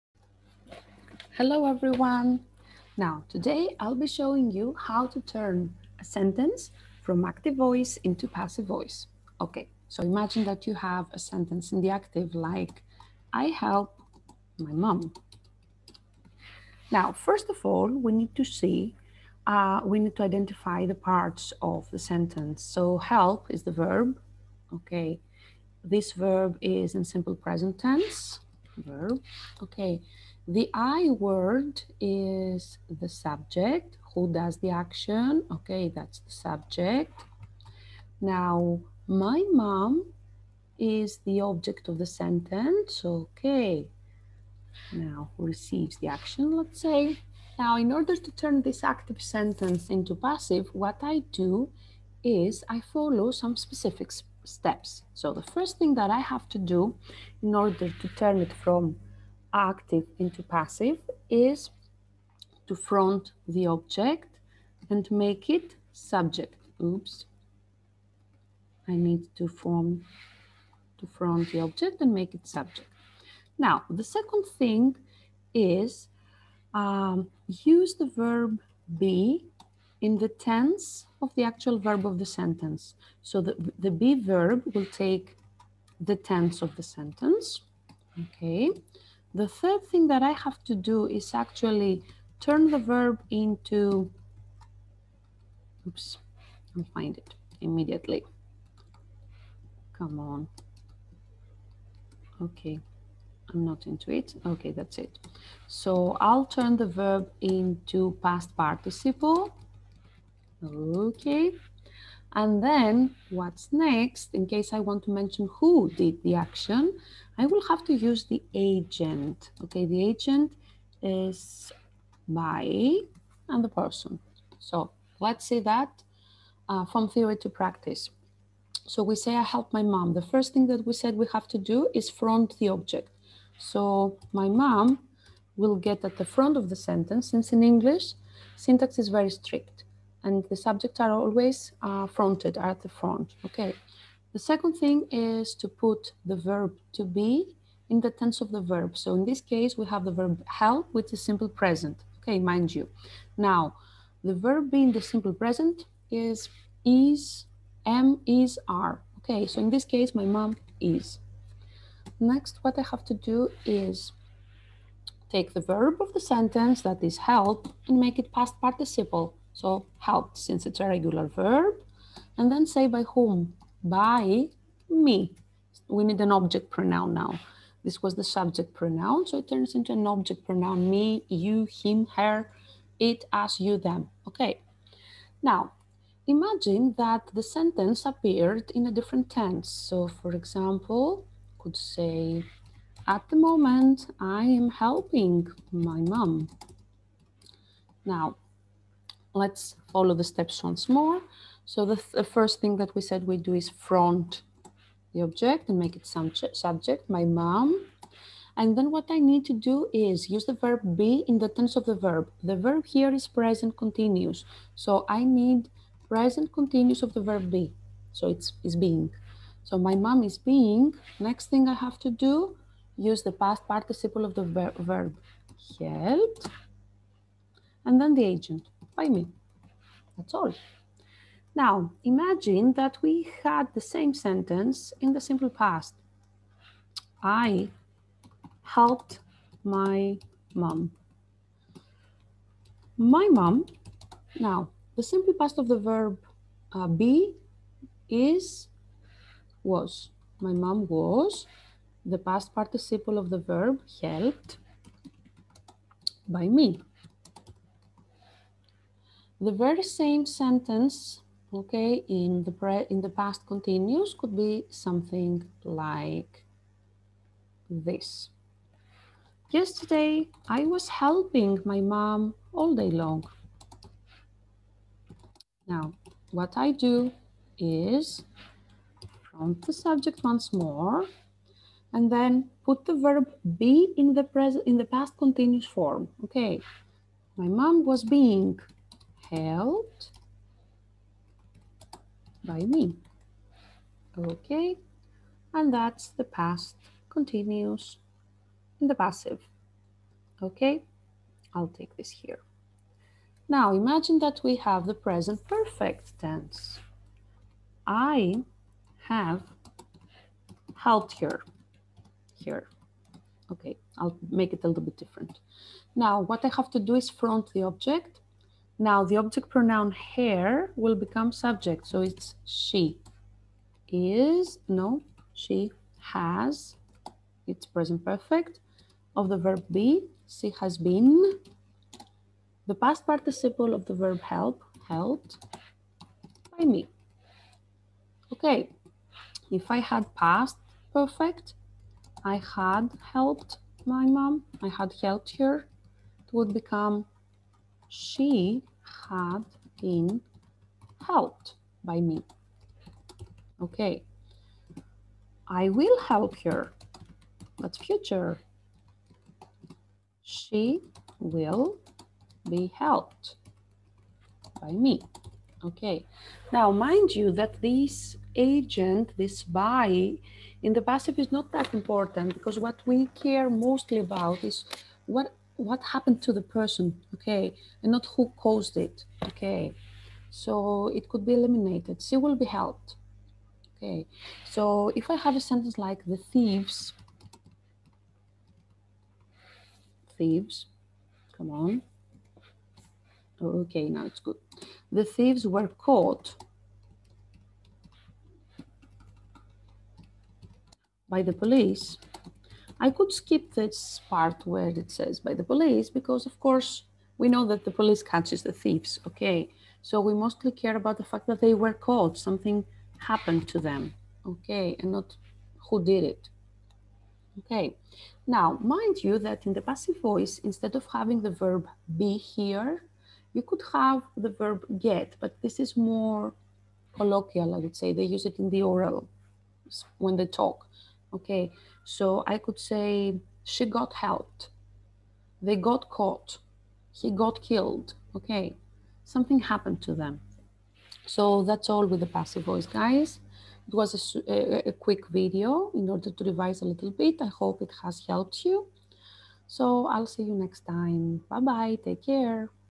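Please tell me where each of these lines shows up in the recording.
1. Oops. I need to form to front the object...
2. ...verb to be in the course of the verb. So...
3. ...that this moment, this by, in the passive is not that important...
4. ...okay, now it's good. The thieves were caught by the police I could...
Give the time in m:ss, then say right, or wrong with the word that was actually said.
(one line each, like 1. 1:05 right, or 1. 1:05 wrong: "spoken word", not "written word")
1. 1:06 right
2. 2:26 wrong: "tense", not "course"
3. 6:07 wrong: "agent", not "moment"
4. 6:33 right.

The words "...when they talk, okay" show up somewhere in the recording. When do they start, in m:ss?
7:09.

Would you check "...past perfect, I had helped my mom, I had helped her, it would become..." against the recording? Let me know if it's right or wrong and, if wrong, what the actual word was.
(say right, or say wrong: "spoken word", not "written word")
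right.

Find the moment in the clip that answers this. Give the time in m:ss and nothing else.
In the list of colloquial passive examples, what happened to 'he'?
7:16.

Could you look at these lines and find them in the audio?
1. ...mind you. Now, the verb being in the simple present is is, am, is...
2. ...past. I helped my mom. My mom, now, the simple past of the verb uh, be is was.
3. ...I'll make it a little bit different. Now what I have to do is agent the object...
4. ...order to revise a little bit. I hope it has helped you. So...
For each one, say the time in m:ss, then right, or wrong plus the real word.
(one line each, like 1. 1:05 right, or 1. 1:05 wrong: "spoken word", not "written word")
1. 2:32 right
2. 3:55 right
3. 5:13 wrong: "front", not "agent"
4. 7:25 right.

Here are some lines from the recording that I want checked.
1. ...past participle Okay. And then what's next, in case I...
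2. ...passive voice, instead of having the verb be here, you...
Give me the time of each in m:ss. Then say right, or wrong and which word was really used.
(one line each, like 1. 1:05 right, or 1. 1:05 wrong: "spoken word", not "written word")
1. 1:48 right
2. 6:59 right.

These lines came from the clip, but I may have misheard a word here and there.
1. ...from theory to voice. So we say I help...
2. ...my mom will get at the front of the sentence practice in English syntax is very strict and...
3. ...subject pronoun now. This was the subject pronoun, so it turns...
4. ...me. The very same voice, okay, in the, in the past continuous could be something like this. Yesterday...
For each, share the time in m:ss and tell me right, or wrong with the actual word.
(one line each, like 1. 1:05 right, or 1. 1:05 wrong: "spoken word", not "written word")
1. 2:06 wrong: "practice", not "voice"
2. 2:14 wrong: "since", not "practice"
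3. 2:56 wrong: "object", not "subject"
4. 4:16 wrong: "sentence", not "voice".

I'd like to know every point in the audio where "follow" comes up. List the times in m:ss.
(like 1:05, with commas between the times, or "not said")
0:52, 3:19.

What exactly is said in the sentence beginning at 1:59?
Okay, the agent is by and the person.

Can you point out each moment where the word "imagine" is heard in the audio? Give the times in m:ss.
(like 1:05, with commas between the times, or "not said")
0:10, 3:06, 3:52, 5:03.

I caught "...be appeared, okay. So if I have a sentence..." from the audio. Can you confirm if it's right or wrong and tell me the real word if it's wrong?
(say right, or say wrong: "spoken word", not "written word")
wrong: "helped", not "appeared".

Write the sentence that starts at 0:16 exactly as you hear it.
Now, first of all, we need to see, uh, we need to identify the parts of the sentence.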